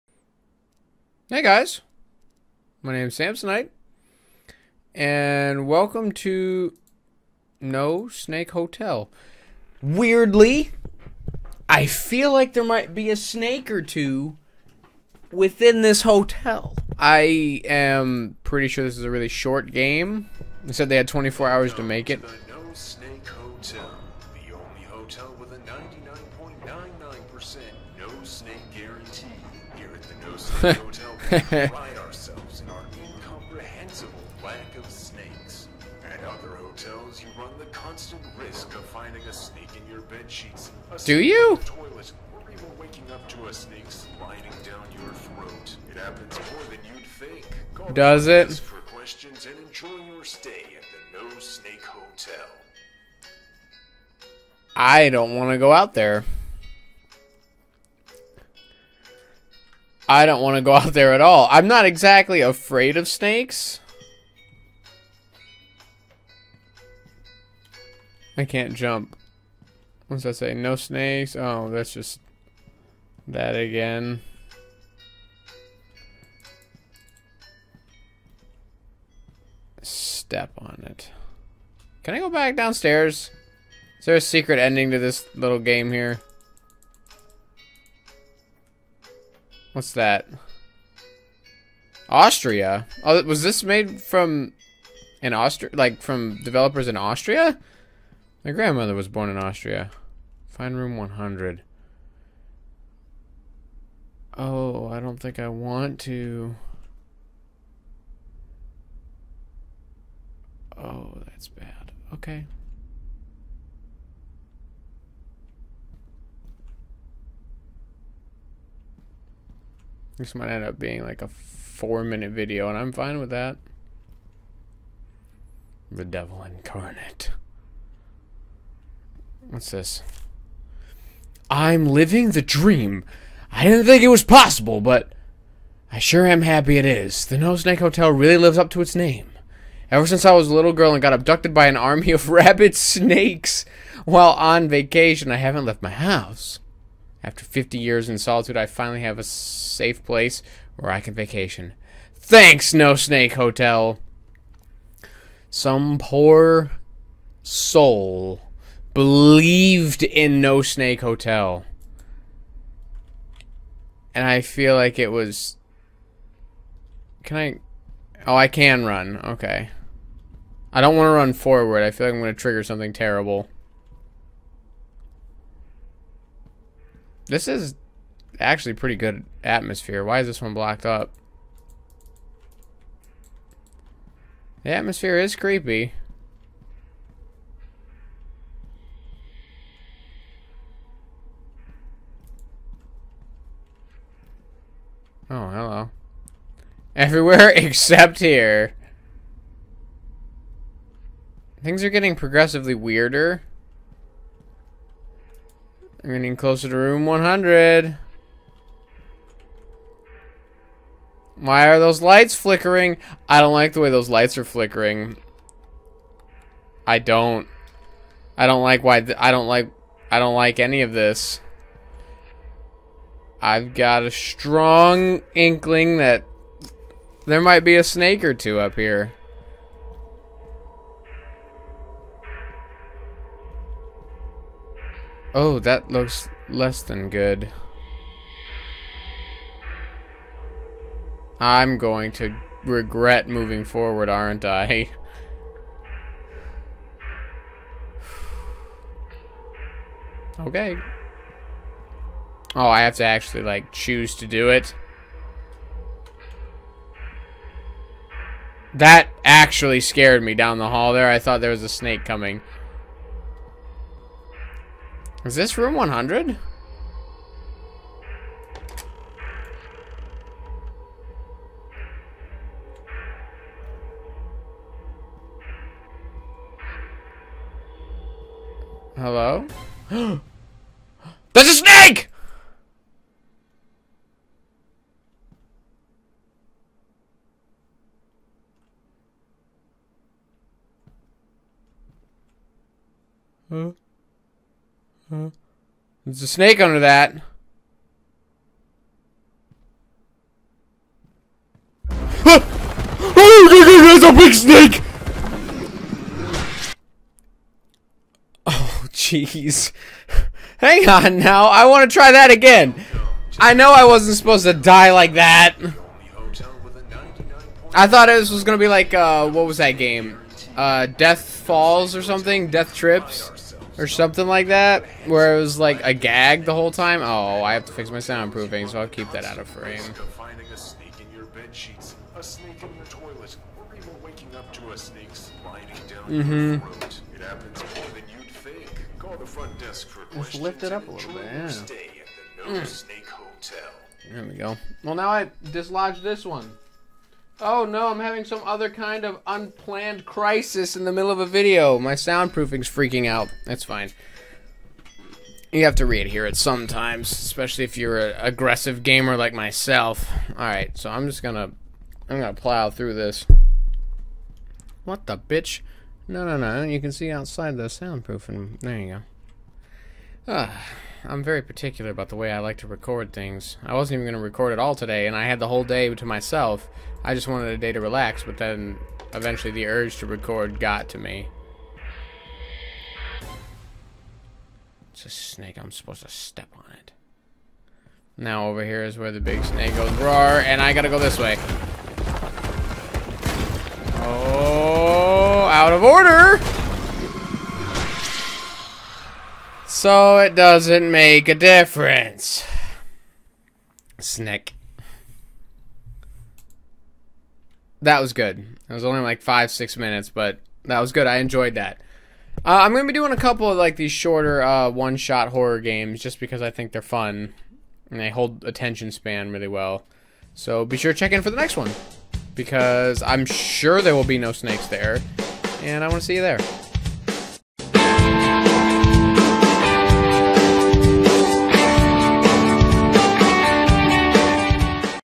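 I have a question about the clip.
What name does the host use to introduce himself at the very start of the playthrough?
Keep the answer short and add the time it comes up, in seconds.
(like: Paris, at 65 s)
Samsonite, at 3 s.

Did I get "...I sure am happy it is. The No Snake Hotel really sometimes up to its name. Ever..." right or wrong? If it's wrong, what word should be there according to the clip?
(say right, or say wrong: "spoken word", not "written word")
wrong: "lives", not "sometimes".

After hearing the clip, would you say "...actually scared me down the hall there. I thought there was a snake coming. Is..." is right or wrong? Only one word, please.
right.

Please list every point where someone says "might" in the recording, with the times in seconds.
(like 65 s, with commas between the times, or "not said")
12 s, 120 s, 227 s.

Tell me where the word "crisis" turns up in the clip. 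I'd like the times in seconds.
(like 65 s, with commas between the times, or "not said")
350 s.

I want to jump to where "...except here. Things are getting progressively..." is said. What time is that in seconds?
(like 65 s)
197 s.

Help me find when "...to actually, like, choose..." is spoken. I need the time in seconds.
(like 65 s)
252 s.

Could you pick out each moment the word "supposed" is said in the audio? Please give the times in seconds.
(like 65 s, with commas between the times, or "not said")
314 s, 385 s.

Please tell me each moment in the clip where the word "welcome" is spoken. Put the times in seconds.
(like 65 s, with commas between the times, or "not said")
5 s.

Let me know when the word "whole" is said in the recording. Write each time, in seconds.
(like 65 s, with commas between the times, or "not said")
326 s, 375 s.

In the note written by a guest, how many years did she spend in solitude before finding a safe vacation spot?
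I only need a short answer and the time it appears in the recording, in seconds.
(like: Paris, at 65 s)
50, at 147 s.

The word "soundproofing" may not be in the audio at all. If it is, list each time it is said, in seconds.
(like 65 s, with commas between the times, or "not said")
327 s, 351 s, 367 s.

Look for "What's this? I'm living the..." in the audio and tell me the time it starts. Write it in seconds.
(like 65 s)
129 s.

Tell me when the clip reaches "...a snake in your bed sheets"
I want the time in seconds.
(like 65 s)
39 s.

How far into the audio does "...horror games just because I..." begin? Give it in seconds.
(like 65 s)
415 s.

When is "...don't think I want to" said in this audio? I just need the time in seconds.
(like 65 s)
104 s.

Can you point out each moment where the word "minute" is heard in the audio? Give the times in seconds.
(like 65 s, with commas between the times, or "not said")
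122 s, 409 s.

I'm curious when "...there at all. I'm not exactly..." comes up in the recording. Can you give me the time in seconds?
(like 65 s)
60 s.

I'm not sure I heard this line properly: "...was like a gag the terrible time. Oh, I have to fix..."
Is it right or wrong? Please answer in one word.
wrong.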